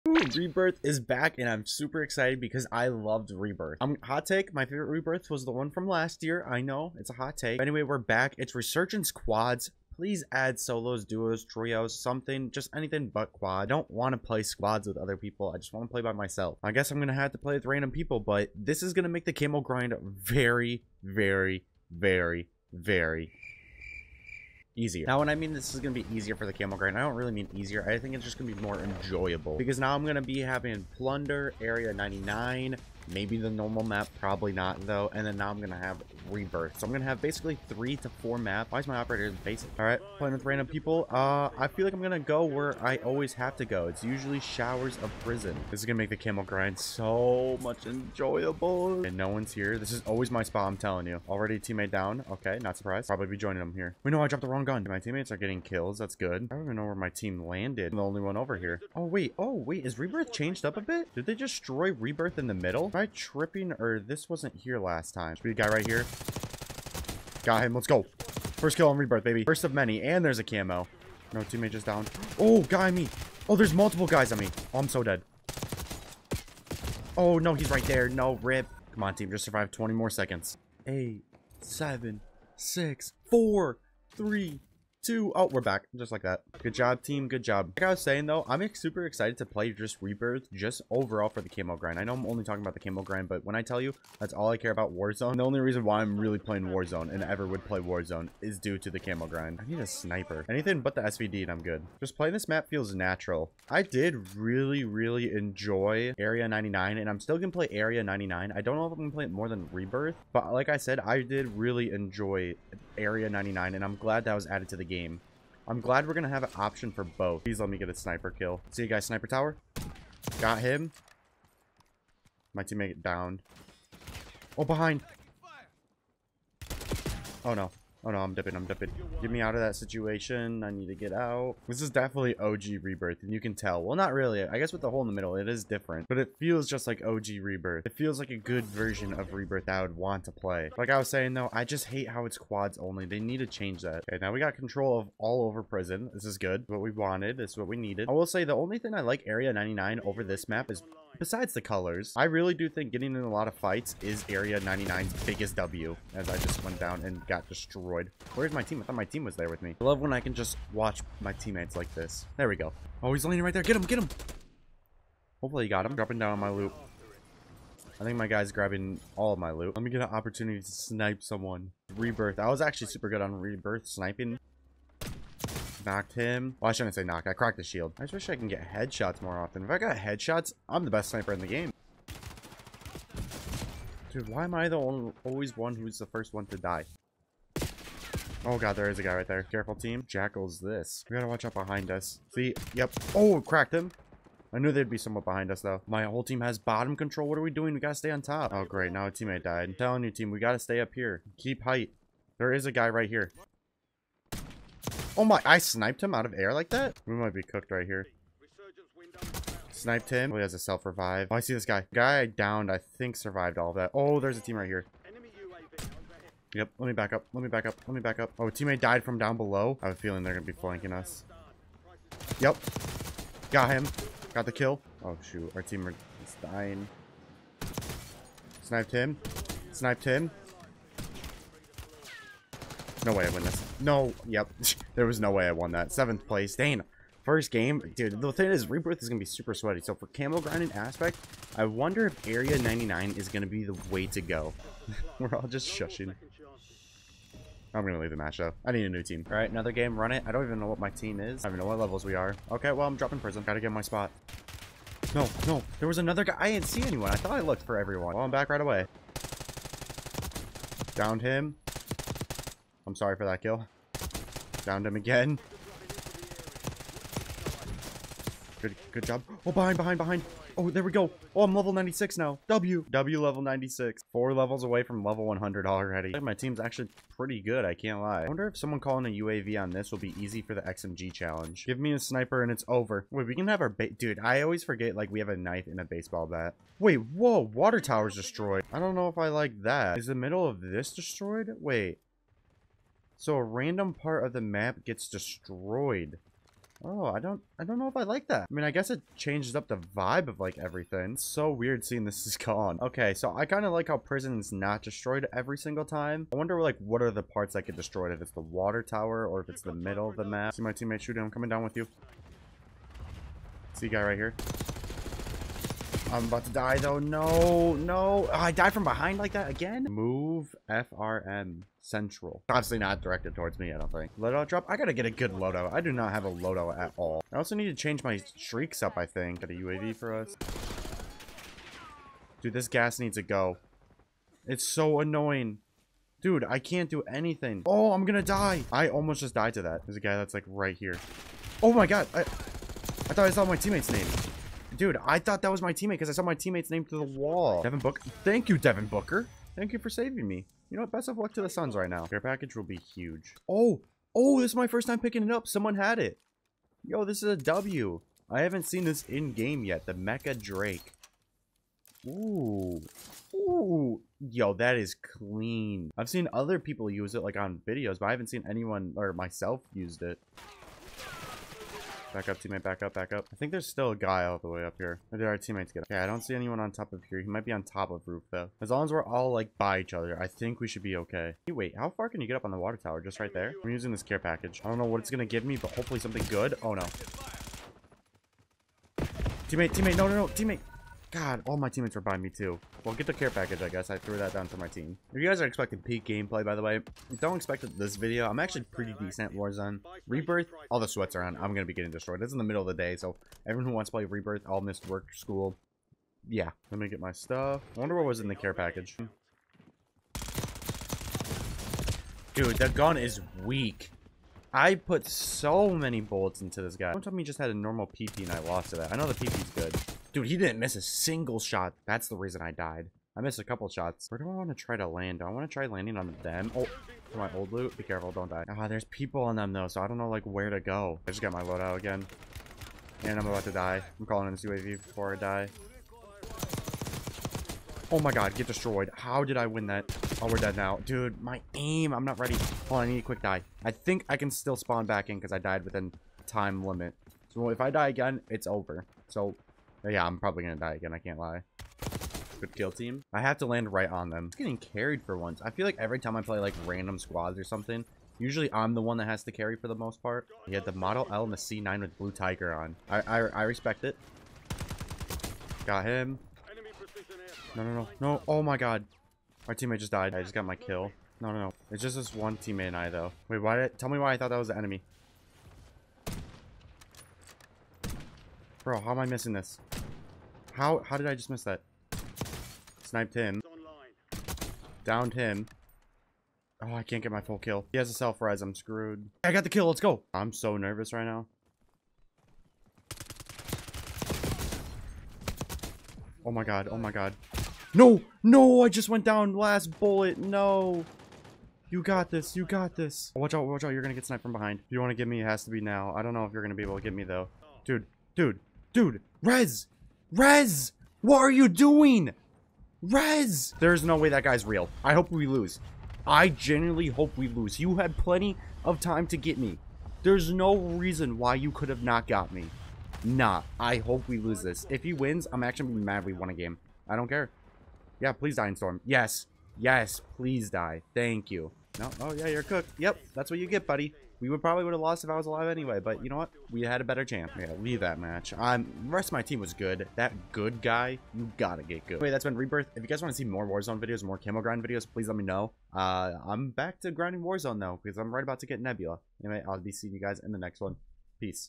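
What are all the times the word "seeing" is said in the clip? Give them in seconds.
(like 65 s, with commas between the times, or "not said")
301 s, 549 s.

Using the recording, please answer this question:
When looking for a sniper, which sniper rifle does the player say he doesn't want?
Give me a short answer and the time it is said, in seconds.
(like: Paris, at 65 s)
SVD, at 101 s.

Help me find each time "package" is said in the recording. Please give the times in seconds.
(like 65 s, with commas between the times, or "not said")
352 s, 384 s, 393 s, 408 s.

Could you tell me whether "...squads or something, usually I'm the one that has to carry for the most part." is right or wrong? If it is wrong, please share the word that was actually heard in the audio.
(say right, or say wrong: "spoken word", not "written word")
right.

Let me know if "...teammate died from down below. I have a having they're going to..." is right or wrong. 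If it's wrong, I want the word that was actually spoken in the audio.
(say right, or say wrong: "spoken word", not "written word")
wrong: "feeling", not "having".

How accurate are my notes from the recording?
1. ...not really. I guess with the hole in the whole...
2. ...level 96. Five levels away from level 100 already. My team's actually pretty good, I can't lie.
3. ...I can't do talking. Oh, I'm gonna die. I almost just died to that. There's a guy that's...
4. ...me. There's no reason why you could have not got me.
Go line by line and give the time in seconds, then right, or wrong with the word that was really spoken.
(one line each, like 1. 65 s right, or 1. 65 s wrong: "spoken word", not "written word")
1. 133 s wrong: "middle", not "whole"
2. 273 s wrong: "Four", not "Five"
3. 336 s wrong: "anything", not "talking"
4. 519 s right.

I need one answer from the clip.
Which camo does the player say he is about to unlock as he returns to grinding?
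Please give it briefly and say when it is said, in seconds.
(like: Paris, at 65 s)
Nebula, at 548 s.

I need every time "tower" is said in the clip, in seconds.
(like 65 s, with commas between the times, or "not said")
119 s, 287 s, 308 s, 382 s.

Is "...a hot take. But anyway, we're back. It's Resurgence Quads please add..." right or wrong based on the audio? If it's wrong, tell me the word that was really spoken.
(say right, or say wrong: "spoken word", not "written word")
right.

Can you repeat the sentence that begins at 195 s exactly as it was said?
My whole team has bottom control.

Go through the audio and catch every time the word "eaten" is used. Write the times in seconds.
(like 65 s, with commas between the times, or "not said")
not said.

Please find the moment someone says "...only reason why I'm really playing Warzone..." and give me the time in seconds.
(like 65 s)
95 s.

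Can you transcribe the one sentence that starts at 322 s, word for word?
Obviously not directed towards me, I don't think.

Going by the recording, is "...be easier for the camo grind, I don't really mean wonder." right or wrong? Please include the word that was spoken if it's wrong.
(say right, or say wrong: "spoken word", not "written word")
wrong: "easier", not "wonder".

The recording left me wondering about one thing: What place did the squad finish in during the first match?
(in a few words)
Seventh.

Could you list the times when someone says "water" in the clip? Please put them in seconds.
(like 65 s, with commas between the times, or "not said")
287 s, 308 s, 382 s.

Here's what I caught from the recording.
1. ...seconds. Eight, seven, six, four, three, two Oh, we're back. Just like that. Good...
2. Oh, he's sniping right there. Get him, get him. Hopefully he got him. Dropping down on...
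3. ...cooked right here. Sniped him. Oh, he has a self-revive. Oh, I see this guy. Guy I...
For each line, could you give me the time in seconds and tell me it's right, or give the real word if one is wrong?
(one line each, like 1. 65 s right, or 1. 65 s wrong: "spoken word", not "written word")
1. 80 s right
2. 163 s wrong: "landing", not "sniping"
3. 207 s right.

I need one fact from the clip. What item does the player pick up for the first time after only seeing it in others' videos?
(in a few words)
Mecha Drake.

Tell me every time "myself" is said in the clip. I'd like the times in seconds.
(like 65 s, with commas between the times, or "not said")
16 s, 369 s.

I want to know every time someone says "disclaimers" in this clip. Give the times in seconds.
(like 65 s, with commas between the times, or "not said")
not said.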